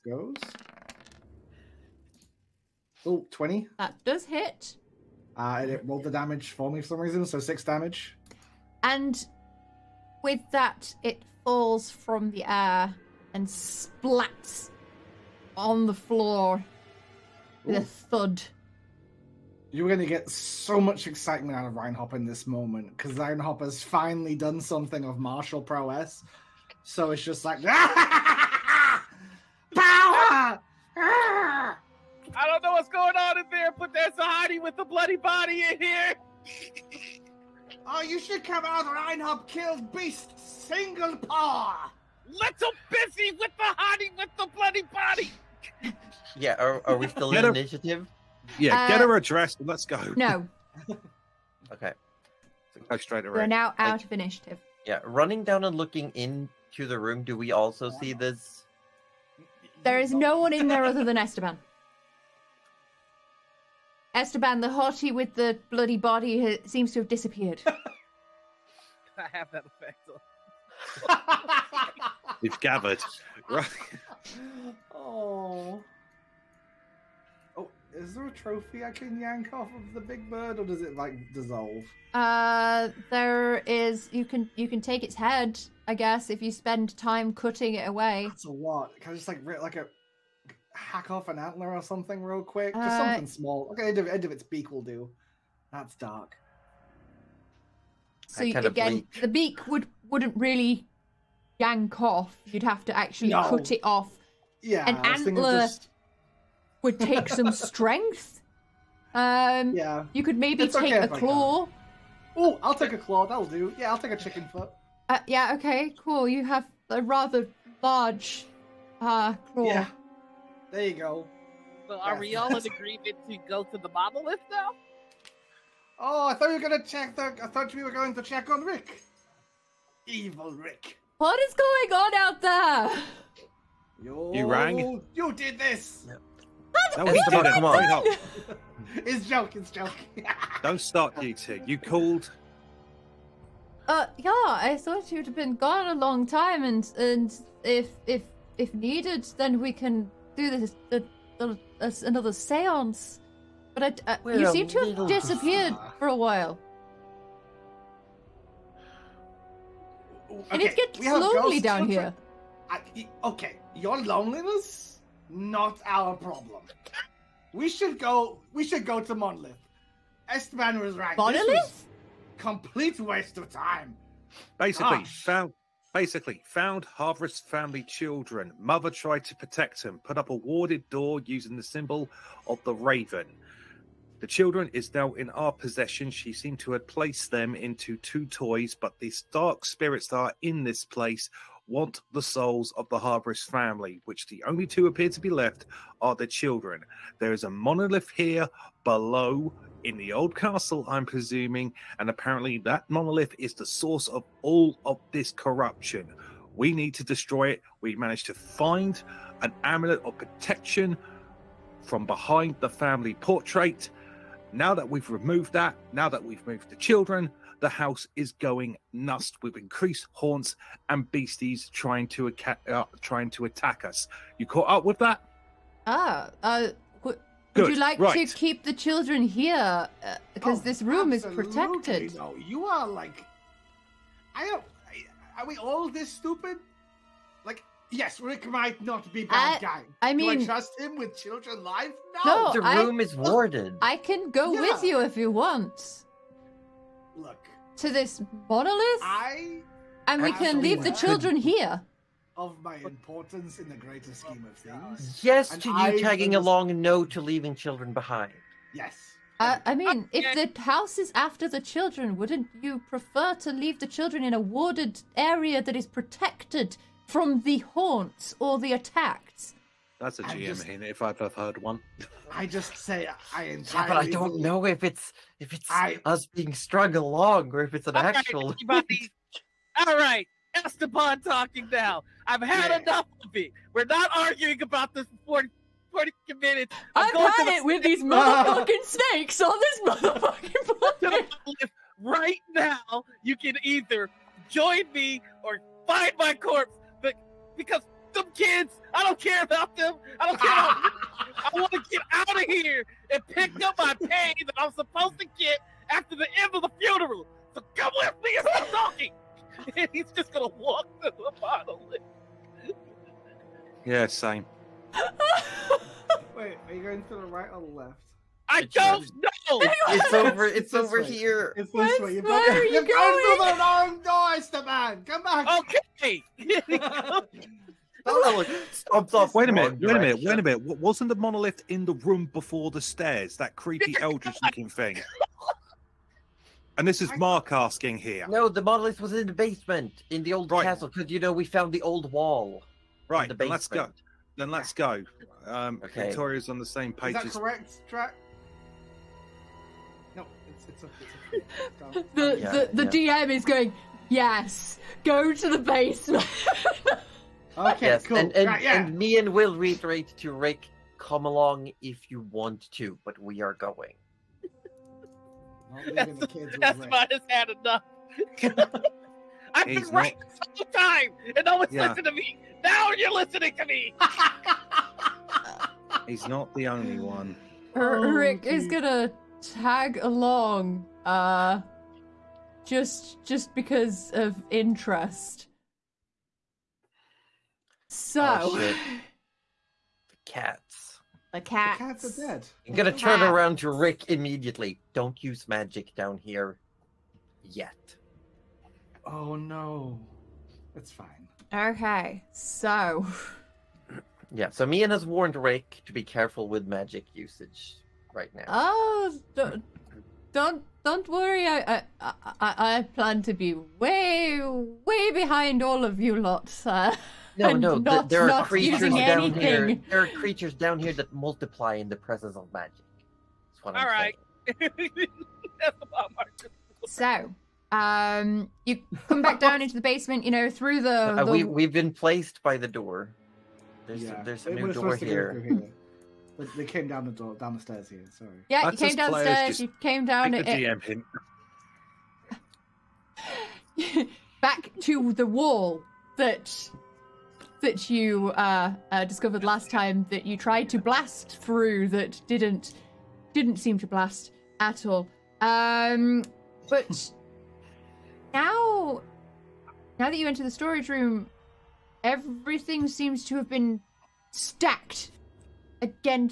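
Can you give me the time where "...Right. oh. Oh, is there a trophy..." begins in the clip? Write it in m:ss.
1:13.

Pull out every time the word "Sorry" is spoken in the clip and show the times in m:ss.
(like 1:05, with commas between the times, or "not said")
7:18.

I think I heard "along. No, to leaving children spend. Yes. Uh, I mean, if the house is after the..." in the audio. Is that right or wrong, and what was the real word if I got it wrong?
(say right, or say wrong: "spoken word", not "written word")
wrong: "behind", not "spend".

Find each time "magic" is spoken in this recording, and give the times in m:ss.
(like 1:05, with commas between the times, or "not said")
6:35, 6:46, 7:02.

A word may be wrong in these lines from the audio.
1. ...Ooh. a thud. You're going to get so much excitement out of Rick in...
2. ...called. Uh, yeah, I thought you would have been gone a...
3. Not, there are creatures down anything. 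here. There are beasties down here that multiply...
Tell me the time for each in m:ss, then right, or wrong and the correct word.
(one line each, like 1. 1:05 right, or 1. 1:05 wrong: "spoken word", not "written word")
1. 0:17 wrong: "Reinhop", not "Rick"
2. 2:21 right
3. 6:57 wrong: "creatures", not "beasties".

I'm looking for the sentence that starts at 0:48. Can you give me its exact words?
Yeah, uh, get her addressed and let's go.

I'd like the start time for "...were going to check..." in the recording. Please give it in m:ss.
2:07.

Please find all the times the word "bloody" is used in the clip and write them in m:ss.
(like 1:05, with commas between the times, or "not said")
0:34, 0:44, 1:05.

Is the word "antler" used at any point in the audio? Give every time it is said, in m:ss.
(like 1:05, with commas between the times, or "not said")
1:31, 1:45.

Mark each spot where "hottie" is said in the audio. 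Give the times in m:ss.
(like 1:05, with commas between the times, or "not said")
0:34, 0:43, 1:04.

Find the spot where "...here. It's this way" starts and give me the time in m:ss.
5:21.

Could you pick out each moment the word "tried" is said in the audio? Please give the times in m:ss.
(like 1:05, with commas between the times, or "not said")
2:58, 7:30.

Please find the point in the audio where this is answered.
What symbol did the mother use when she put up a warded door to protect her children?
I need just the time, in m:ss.
3:01.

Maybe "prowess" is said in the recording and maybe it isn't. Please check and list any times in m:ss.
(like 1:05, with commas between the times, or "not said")
0:25.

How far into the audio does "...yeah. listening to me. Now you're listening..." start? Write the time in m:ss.
6:11.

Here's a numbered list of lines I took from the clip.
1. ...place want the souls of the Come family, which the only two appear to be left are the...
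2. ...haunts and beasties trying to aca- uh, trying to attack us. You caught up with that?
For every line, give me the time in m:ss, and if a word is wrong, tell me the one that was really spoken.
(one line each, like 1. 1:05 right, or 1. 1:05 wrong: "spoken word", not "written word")
1. 3:10 wrong: "Harvest", not "Come"
2. 3:40 right.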